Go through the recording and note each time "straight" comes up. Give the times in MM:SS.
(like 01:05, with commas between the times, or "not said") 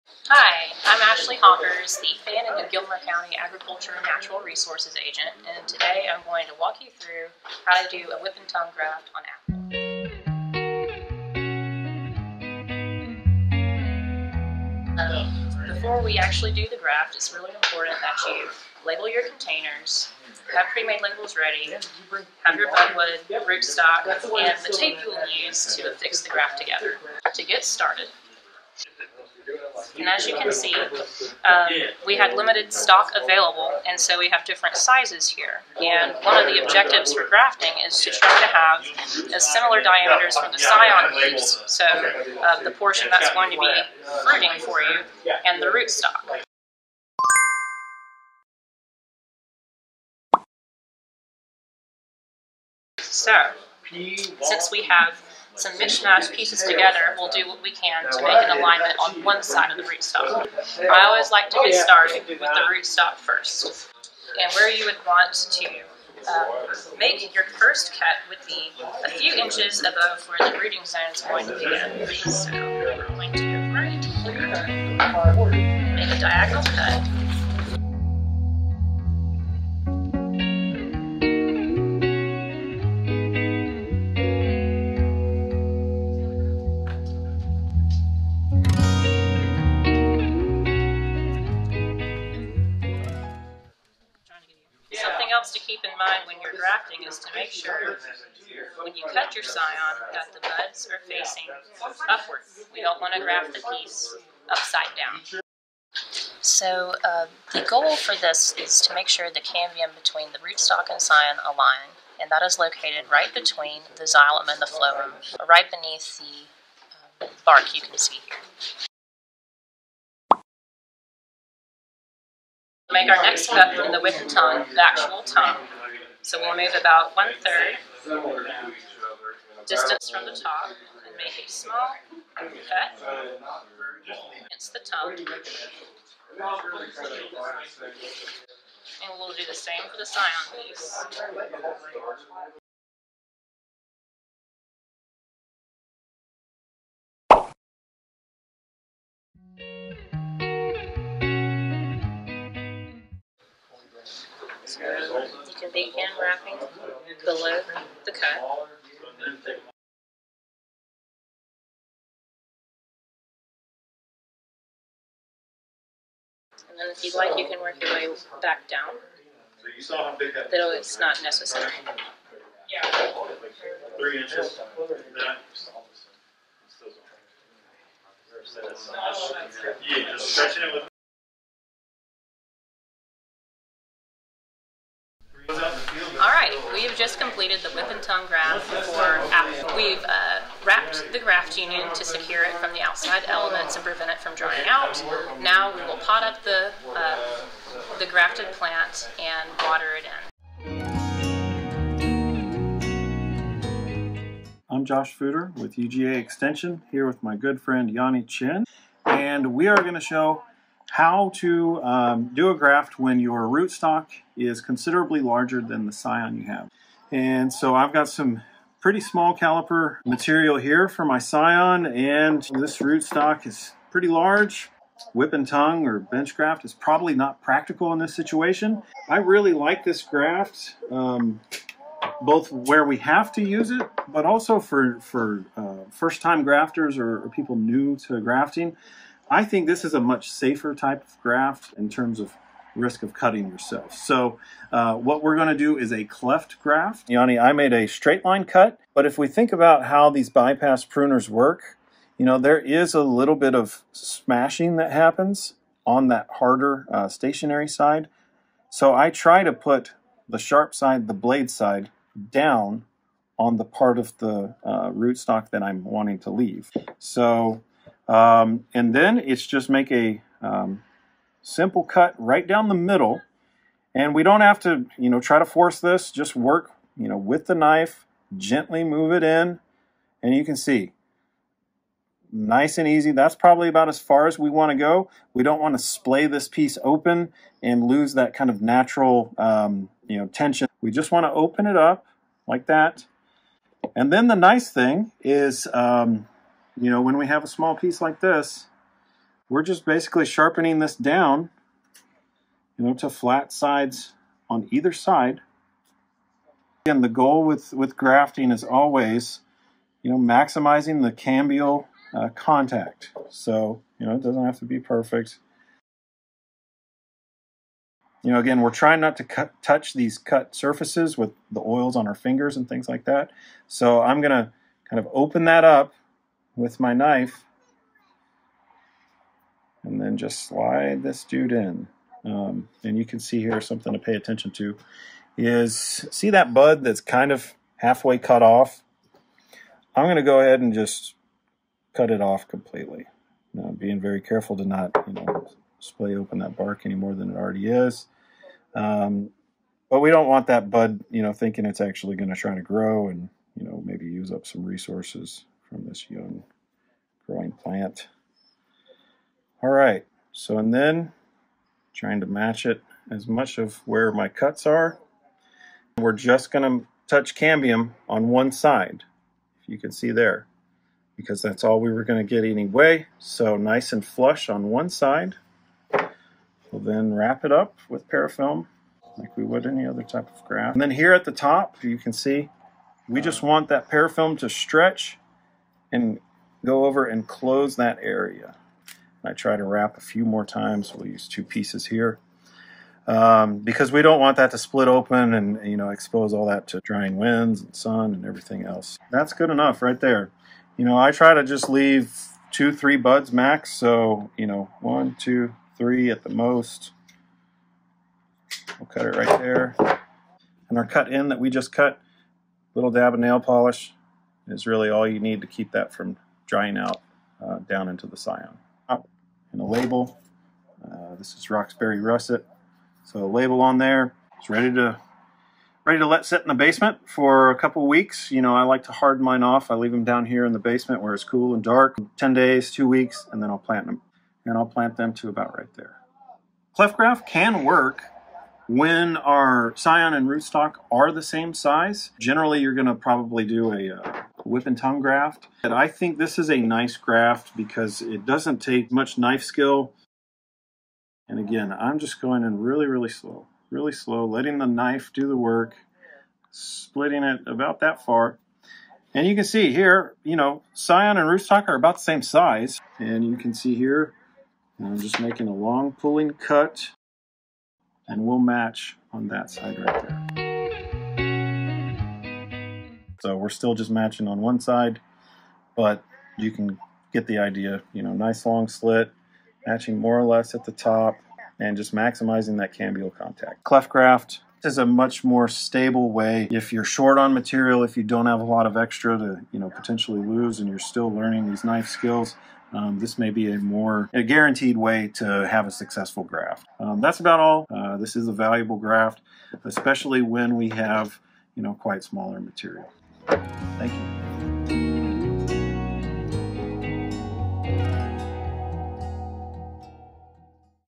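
04:07.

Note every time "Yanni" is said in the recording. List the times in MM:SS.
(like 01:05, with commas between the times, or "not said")
03:27, 04:07.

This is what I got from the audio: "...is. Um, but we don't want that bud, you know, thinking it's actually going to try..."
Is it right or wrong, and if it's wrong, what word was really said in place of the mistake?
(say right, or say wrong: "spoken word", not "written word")
right.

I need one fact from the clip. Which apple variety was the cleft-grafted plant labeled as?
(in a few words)
Roxbury Russet.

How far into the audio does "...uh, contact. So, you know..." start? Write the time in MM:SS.
05:12.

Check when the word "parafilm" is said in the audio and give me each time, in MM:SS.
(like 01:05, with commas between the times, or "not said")
06:18, 06:23.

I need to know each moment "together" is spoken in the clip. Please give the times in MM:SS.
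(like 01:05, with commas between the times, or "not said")
00:26, 00:56.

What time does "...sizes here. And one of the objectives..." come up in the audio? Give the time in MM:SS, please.
00:34.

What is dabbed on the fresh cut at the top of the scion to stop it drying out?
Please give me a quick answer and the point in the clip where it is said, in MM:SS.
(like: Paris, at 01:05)
Nail polish, at 06:53.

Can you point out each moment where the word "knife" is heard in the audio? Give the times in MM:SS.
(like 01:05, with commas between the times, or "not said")
04:37, 05:26, 07:29, 07:34, 08:11.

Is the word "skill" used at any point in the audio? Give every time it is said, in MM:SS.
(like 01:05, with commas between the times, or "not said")
07:29, 08:11.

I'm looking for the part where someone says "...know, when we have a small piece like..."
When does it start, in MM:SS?
04:56.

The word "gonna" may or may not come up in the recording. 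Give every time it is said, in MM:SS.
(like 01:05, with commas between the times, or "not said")
06:06, 06:12.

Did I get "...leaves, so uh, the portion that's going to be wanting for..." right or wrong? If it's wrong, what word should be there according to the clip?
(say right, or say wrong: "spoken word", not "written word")
wrong: "fruiting", not "wanting".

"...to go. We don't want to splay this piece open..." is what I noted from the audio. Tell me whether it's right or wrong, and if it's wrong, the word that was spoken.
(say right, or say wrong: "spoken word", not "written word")
right.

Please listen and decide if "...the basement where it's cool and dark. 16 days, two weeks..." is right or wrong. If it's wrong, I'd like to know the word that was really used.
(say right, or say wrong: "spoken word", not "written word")
wrong: "10", not "16".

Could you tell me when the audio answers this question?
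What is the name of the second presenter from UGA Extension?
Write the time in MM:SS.
03:24.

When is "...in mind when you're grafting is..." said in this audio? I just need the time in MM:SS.
01:35.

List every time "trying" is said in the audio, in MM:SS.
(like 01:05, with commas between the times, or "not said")
05:18, 06:01.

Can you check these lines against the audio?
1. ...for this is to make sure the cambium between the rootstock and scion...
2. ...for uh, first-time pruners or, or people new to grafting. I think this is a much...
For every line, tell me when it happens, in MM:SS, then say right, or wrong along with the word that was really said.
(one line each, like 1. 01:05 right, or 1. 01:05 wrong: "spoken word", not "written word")
1. 01:47 right
2. 03:54 wrong: "grafters", not "pruners".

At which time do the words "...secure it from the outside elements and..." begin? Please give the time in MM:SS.
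03:12.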